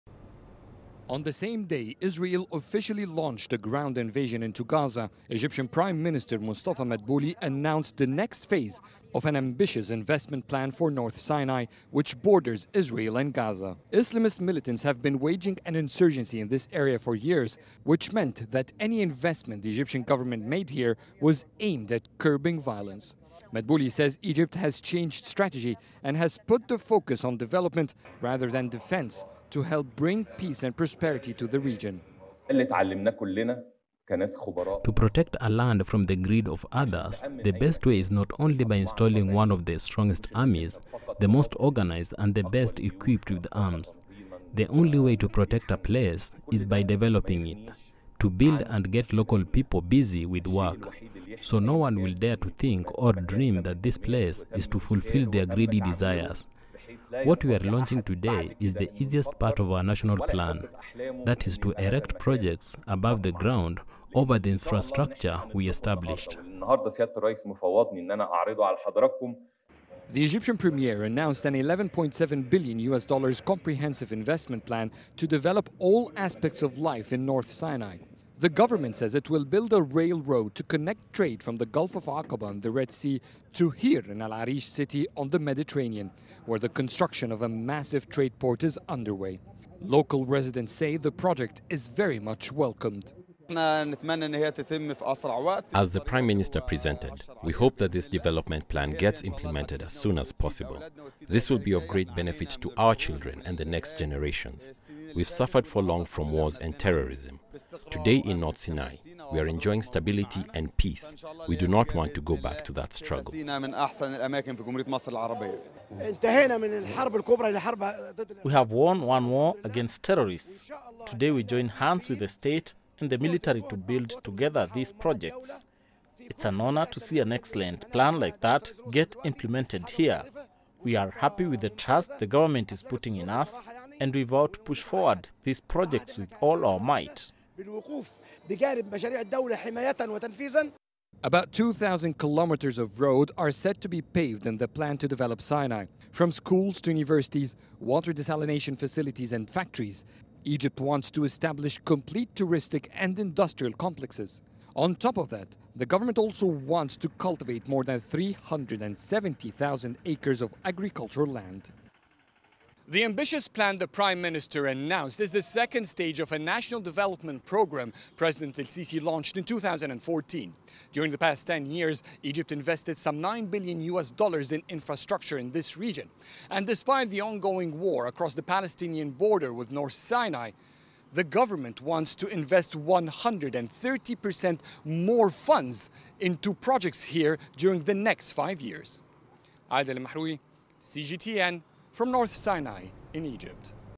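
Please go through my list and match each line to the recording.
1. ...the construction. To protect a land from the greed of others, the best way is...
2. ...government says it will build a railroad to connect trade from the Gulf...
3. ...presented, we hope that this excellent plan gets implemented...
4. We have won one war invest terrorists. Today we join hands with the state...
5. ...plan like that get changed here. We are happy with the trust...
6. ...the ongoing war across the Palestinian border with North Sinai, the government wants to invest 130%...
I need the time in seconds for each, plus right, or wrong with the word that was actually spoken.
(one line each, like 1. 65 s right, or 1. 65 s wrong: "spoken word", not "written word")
1. 31 s wrong: "region", not "construction"
2. 78 s right
3. 96 s wrong: "development", not "excellent"
4. 118 s wrong: "against", not "invest"
5. 127 s wrong: "implemented", not "changed"
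6. 177 s right.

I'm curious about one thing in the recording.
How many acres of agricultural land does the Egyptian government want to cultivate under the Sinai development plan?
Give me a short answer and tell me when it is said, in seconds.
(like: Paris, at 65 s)
370,000 acres, at 157 s.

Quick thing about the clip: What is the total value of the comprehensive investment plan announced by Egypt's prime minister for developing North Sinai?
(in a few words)
$11.7 billion.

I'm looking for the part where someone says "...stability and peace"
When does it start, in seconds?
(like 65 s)
109 s.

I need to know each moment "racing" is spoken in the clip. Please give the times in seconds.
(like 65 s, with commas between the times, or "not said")
not said.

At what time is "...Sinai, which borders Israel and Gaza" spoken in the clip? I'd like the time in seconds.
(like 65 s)
11 s.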